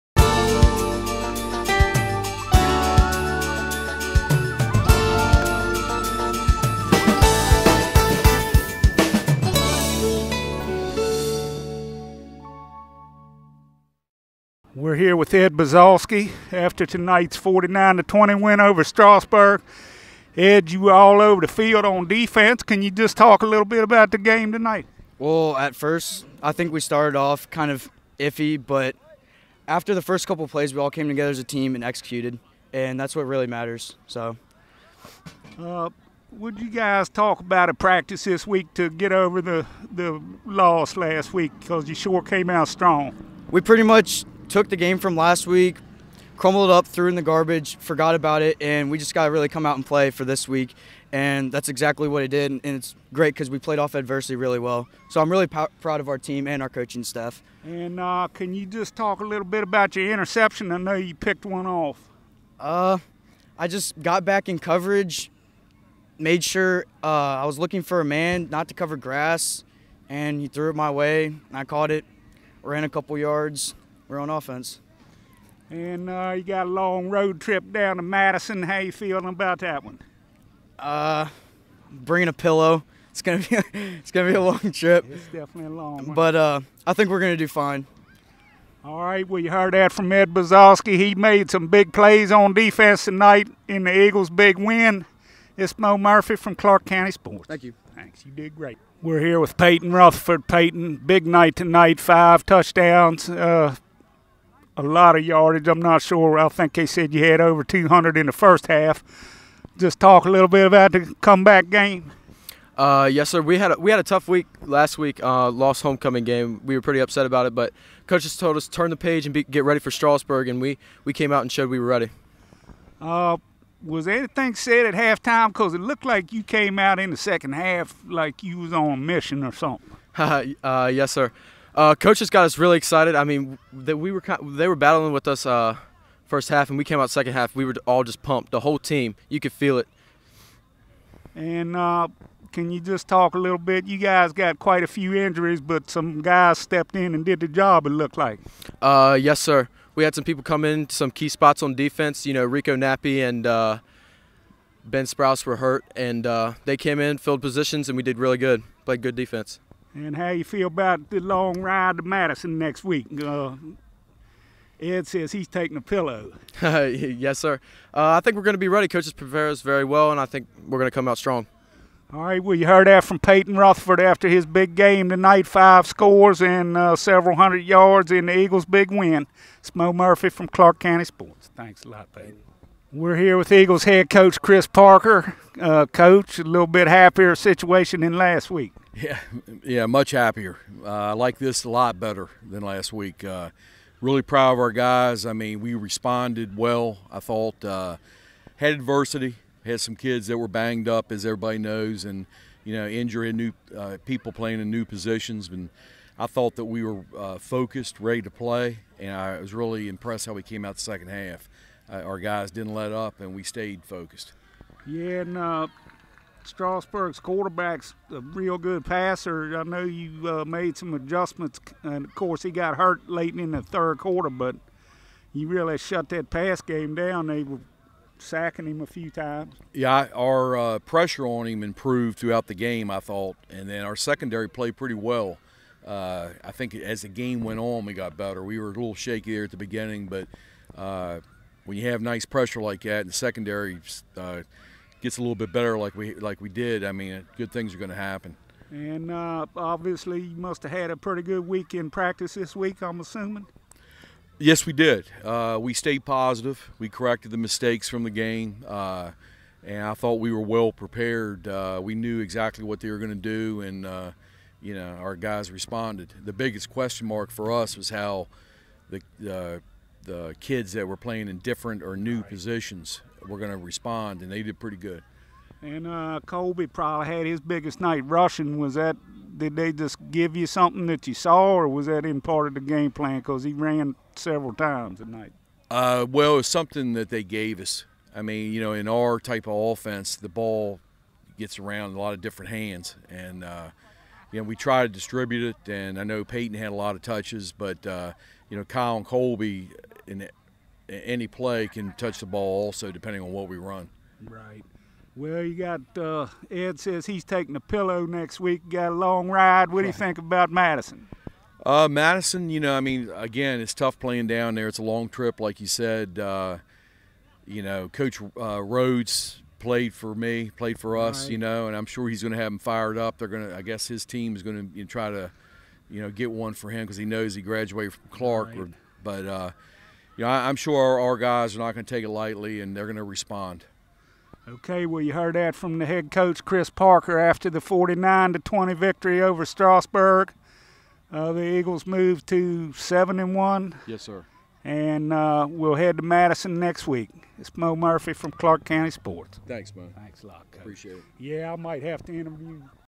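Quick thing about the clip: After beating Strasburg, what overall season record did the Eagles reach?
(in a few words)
7-1.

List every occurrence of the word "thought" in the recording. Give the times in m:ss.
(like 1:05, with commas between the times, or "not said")
3:17, 3:26, 3:53, 4:19.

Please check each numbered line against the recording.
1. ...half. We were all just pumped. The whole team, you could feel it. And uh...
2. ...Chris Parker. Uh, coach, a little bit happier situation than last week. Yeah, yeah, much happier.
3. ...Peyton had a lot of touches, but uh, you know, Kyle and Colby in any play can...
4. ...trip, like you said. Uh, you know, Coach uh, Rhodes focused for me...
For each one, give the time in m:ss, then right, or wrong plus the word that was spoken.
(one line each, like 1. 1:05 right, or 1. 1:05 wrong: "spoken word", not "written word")
1. 2:17 right
2. 3:04 right
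3. 4:56 right
4. 5:15 wrong: "played", not "focused".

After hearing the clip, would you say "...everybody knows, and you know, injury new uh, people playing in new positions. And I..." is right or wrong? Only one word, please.
right.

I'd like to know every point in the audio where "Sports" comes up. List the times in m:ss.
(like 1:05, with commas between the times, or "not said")
1:37, 3:01, 5:48.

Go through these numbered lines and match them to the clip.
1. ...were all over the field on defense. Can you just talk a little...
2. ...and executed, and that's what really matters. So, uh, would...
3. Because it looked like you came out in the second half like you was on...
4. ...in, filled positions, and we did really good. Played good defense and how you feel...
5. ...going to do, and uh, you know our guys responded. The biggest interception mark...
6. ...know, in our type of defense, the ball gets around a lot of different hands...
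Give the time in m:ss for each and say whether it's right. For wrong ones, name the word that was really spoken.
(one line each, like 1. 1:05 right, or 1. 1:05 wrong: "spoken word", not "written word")
1. 0:20 right
2. 0:31 right
3. 2:05 right
4. 2:36 right
5. 4:22 wrong: "question", not "interception"
6. 4:48 wrong: "offense", not "defense".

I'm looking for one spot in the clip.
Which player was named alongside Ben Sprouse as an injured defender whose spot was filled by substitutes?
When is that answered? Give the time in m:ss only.
2:32.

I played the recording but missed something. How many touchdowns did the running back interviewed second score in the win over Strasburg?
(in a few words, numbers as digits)
5.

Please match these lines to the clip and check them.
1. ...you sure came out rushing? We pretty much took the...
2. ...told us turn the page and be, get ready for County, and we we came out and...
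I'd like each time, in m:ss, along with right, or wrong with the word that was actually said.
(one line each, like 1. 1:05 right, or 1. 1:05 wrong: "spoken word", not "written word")
1. 0:41 wrong: "strong", not "rushing"
2. 1:58 wrong: "Strasburg", not "County".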